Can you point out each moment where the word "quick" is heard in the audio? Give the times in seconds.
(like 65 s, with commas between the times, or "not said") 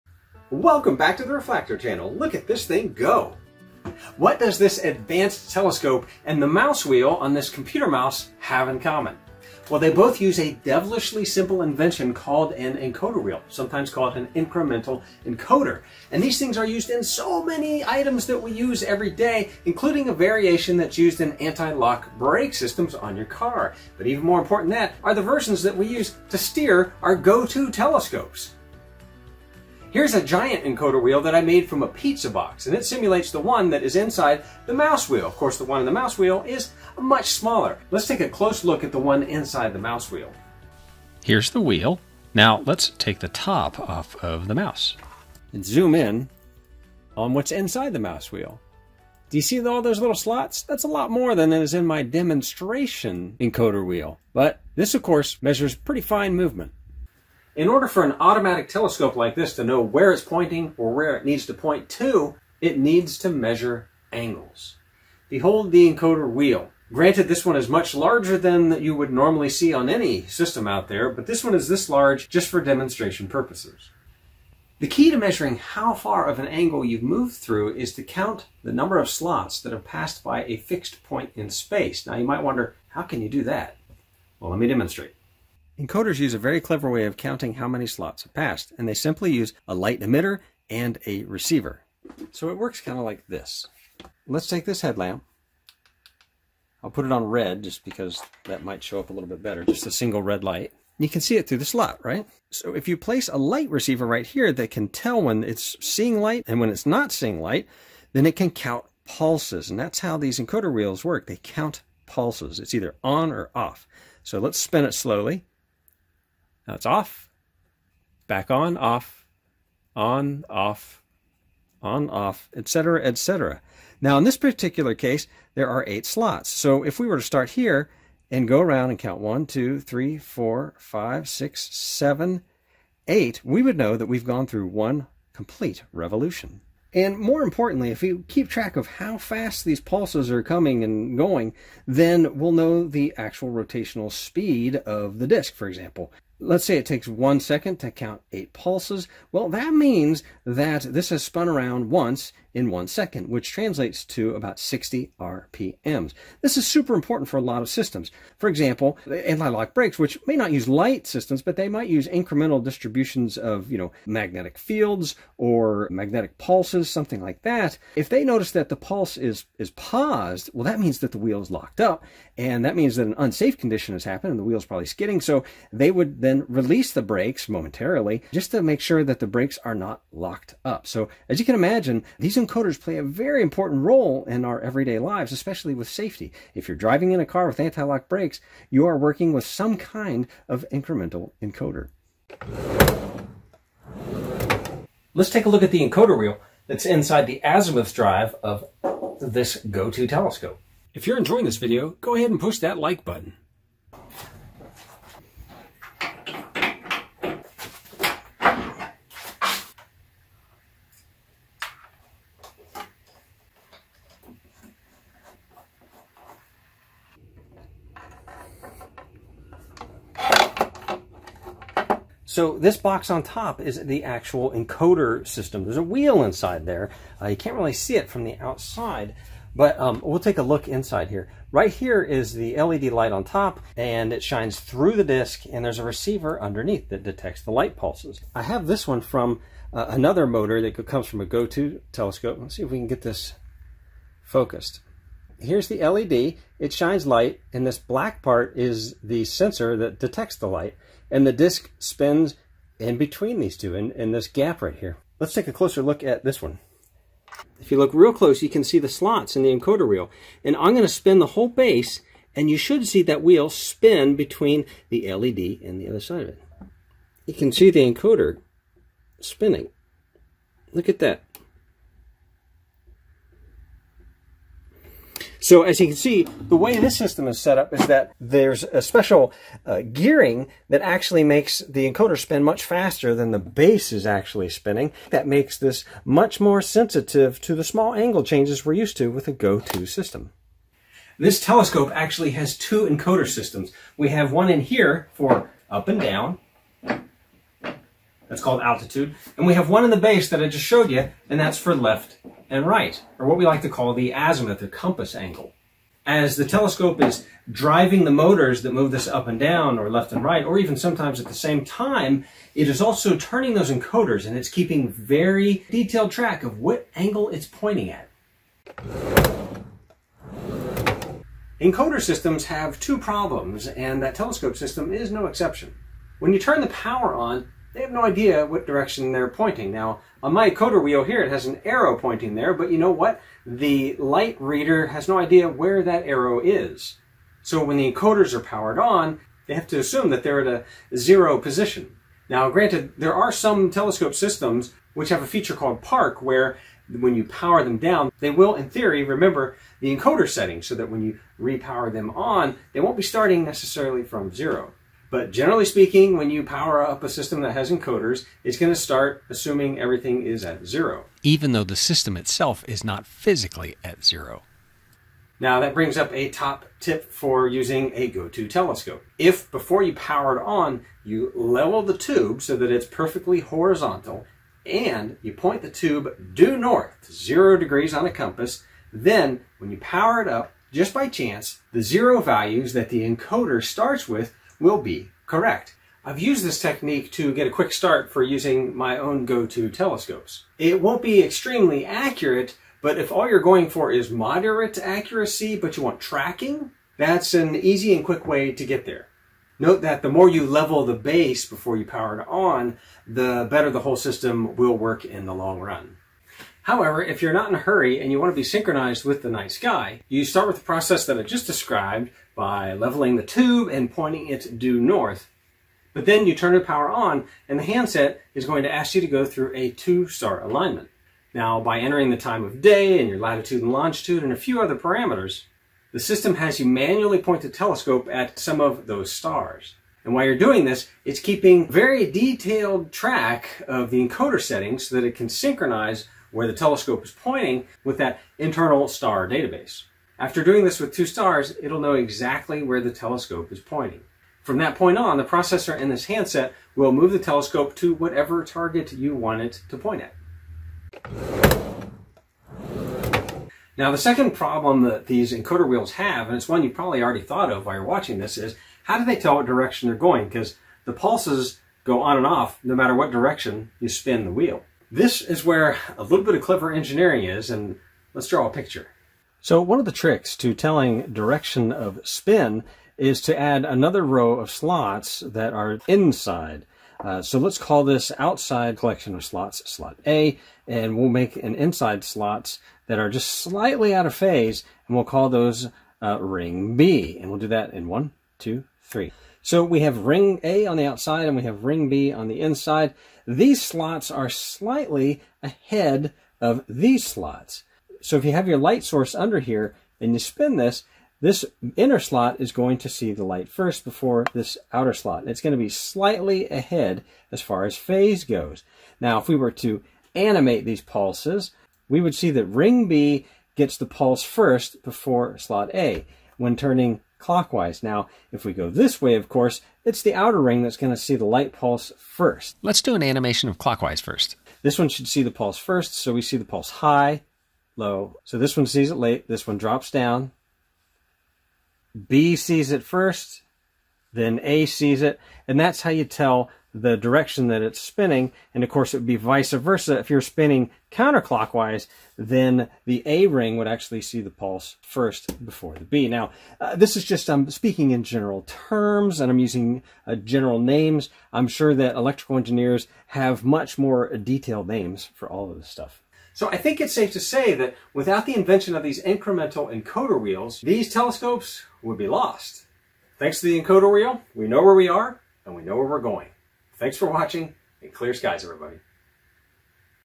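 387 s, 398 s.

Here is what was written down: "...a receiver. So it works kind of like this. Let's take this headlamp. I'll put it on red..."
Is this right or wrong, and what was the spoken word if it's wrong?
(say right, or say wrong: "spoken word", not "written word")
right.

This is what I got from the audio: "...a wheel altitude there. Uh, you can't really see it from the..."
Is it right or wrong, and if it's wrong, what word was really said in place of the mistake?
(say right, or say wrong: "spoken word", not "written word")
wrong: "inside", not "altitude".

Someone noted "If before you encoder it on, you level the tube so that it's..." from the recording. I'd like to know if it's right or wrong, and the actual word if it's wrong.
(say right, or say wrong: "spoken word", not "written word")
wrong: "power", not "encoder".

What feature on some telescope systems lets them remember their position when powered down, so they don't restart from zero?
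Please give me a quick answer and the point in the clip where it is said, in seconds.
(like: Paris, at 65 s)
Park, at 345 s.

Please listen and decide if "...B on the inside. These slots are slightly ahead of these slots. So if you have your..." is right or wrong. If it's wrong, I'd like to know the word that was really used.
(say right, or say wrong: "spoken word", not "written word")
right.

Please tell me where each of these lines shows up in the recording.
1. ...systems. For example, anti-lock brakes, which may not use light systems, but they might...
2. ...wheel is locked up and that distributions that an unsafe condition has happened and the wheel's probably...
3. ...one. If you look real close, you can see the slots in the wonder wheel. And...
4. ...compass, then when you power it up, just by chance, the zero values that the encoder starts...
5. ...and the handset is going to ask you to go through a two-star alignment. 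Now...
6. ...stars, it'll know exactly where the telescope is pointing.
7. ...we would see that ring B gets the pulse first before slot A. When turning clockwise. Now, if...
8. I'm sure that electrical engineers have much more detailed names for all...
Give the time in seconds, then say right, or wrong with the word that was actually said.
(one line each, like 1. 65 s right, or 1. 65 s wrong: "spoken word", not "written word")
1. 157 s right
2. 171 s wrong: "means", not "distributions"
3. 256 s wrong: "encoder", not "wonder"
4. 378 s right
5. 417 s right
6. 441 s right
7. 511 s right
8. 551 s right.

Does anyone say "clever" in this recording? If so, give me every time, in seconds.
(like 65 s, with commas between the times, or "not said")
86 s, 466 s.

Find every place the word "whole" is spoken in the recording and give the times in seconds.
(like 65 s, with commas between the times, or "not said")
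261 s, 403 s.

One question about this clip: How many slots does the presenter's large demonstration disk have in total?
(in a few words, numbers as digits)
8.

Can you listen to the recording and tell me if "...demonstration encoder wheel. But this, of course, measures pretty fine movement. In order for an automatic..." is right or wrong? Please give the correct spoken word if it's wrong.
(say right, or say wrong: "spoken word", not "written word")
right.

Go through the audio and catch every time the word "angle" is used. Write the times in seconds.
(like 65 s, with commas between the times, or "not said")
64 s, 76 s, 287 s, 305 s, 316 s.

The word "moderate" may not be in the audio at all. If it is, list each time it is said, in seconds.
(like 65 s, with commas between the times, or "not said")
394 s.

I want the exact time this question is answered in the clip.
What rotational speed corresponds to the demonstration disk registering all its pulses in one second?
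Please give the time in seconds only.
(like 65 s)
154 s.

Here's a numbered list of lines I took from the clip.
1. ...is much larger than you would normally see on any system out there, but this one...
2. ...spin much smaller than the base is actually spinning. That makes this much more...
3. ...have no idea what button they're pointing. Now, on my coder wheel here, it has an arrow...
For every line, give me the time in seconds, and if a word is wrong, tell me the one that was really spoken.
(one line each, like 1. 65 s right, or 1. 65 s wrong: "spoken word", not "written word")
1. 67 s right
2. 282 s wrong: "faster", not "smaller"
3. 327 s wrong: "direction", not "button".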